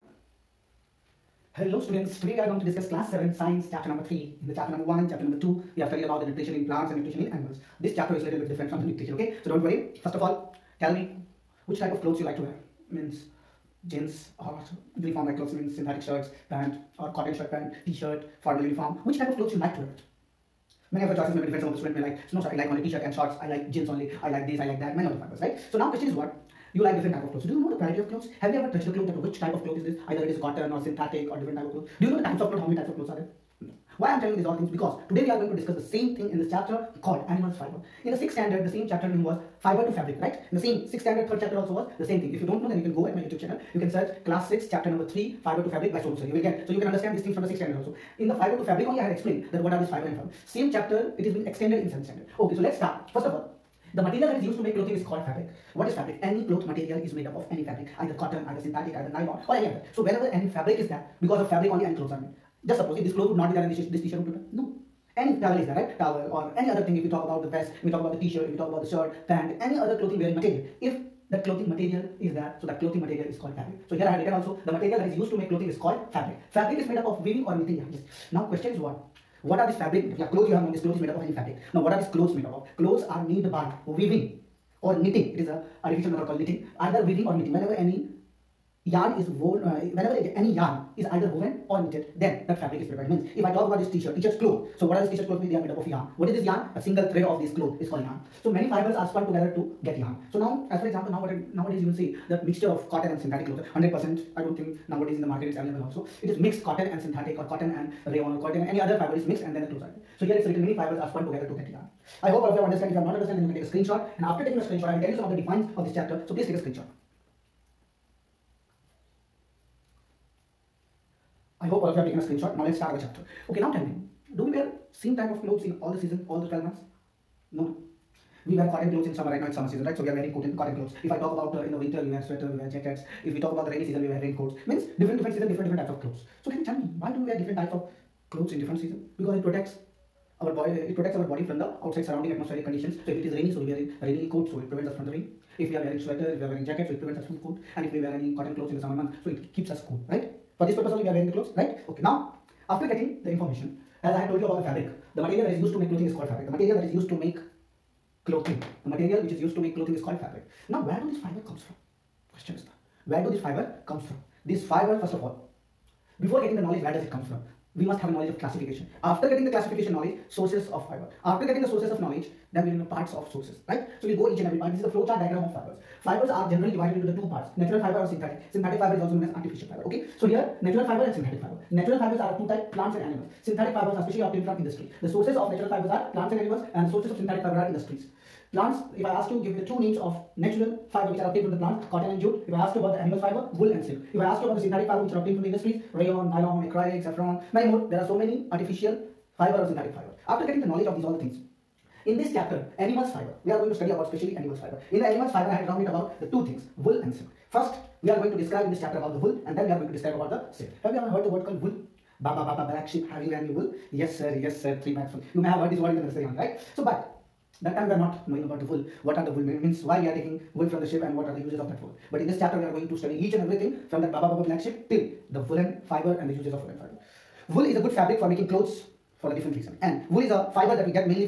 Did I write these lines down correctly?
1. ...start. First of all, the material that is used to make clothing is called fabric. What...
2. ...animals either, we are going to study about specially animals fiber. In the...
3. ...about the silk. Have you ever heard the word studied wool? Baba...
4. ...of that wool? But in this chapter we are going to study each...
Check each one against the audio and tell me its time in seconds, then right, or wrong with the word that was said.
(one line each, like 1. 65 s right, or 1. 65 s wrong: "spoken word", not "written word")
1. 52 s right
2. 202 s wrong: "fiber", not "either"
3. 210 s wrong: "called", not "studied"
4. 221 s right.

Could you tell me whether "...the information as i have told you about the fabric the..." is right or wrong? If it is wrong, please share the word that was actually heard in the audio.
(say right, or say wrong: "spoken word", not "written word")
right.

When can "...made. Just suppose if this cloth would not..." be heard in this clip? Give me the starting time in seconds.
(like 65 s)
62 s.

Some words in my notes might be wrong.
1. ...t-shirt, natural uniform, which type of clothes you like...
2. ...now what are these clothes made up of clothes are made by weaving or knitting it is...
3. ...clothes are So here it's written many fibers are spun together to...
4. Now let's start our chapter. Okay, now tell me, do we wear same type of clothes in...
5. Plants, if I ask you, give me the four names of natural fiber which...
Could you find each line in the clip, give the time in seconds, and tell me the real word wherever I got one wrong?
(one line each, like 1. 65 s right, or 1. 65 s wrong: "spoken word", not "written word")
1. 17 s wrong: "formal", not "natural"
2. 81 s right
3. 109 s right
4. 122 s right
5. 188 s wrong: "two", not "four".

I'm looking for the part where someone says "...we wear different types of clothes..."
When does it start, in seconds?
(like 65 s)
137 s.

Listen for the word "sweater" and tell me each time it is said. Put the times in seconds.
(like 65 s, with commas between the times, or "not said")
132 s, 146 s.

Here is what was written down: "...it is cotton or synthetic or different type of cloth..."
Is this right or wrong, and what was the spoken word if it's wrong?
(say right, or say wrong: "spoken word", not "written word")
right.